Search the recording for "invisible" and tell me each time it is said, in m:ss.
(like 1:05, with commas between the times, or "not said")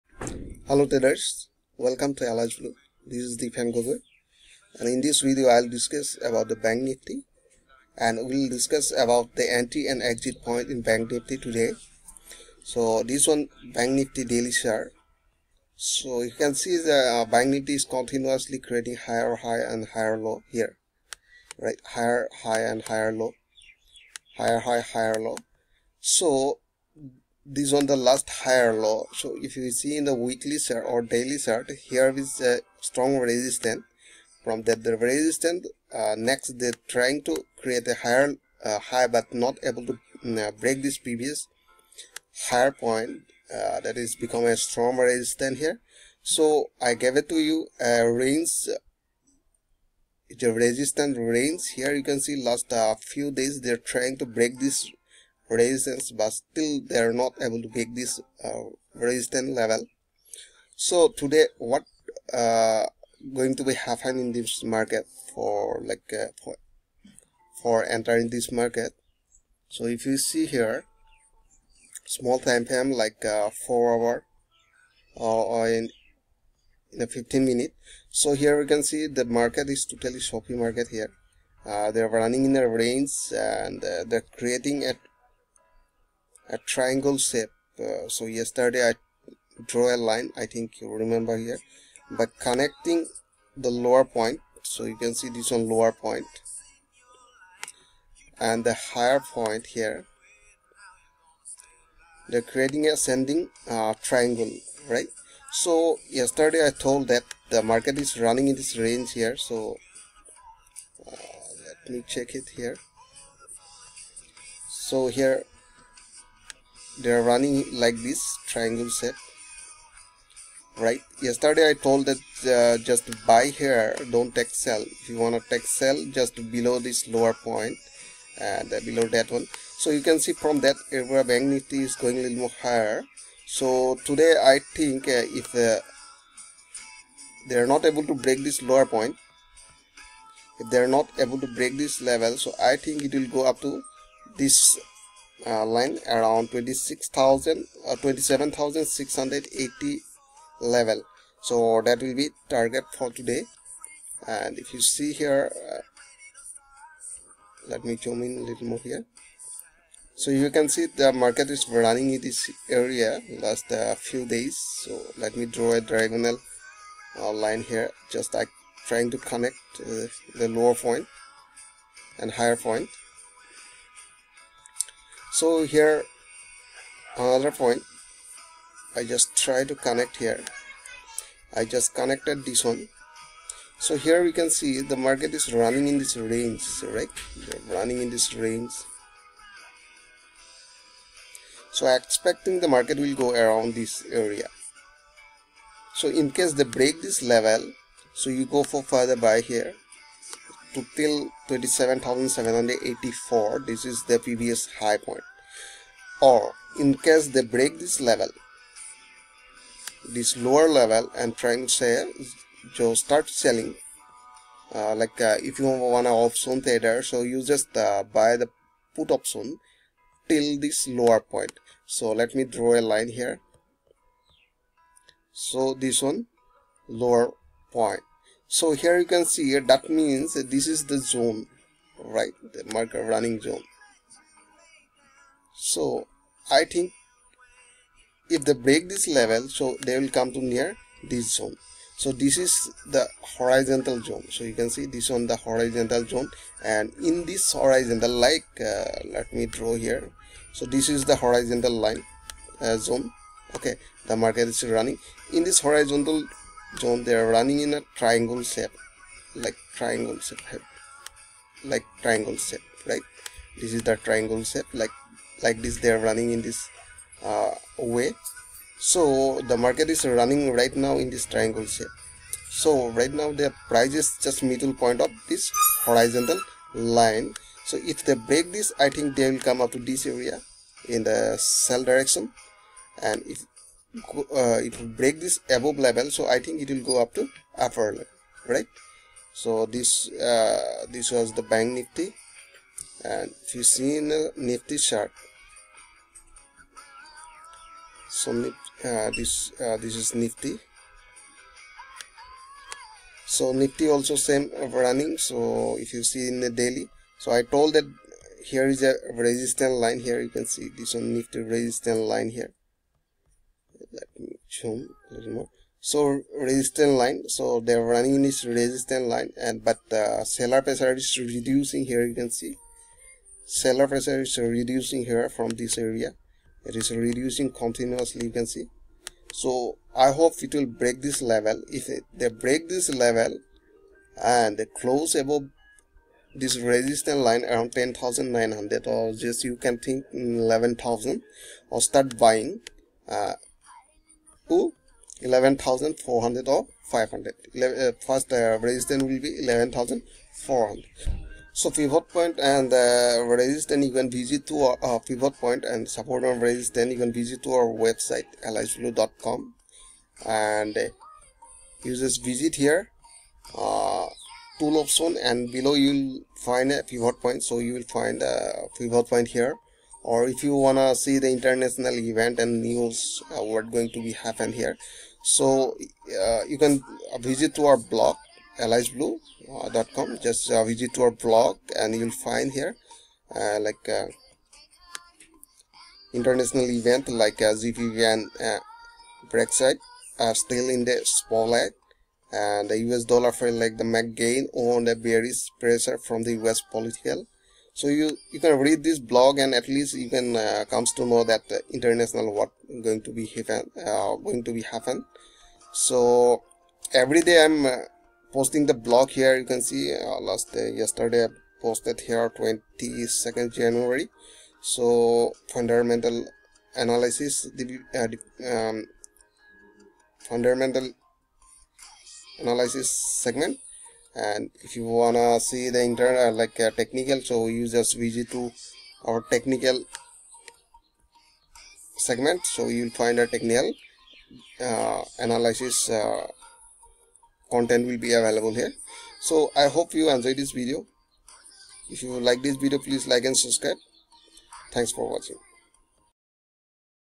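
not said.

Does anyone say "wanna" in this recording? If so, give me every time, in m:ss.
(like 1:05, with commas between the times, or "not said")
6:10, 7:04.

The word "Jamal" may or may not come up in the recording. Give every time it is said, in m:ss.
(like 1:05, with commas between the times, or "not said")
not said.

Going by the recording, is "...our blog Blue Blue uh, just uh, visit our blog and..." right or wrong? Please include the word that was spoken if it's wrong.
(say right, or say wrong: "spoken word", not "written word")
wrong: "Alice", not "Blue".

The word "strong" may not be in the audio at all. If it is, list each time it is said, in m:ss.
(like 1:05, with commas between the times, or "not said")
0:32, 0:44.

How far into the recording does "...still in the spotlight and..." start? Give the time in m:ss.
6:30.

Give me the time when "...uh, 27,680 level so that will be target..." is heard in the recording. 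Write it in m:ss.
2:27.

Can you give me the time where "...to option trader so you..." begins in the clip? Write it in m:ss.
3:36.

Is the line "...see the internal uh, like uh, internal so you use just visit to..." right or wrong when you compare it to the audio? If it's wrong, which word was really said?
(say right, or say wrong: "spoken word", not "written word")
wrong: "technical", not "internal".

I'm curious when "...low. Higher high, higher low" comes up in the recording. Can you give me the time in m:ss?
0:23.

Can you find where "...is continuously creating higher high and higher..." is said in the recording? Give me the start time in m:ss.
0:17.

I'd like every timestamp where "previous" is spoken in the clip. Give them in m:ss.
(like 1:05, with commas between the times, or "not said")
0:40, 3:24.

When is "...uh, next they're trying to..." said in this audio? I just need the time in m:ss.
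0:35.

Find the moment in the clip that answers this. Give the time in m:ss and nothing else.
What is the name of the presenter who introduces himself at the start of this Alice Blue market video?
0:03.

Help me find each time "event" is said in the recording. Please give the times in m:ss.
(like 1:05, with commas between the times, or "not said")
6:11, 6:26.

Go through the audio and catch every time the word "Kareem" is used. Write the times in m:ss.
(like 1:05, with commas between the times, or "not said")
not said.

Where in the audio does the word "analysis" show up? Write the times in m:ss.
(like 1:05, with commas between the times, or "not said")
6:56, 7:02, 7:15.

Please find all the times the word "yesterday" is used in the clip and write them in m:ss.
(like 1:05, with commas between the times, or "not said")
1:28, 1:46, 2:01, 6:50.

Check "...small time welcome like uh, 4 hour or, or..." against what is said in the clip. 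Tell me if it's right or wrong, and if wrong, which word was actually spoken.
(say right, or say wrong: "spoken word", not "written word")
wrong: "frame", not "welcome".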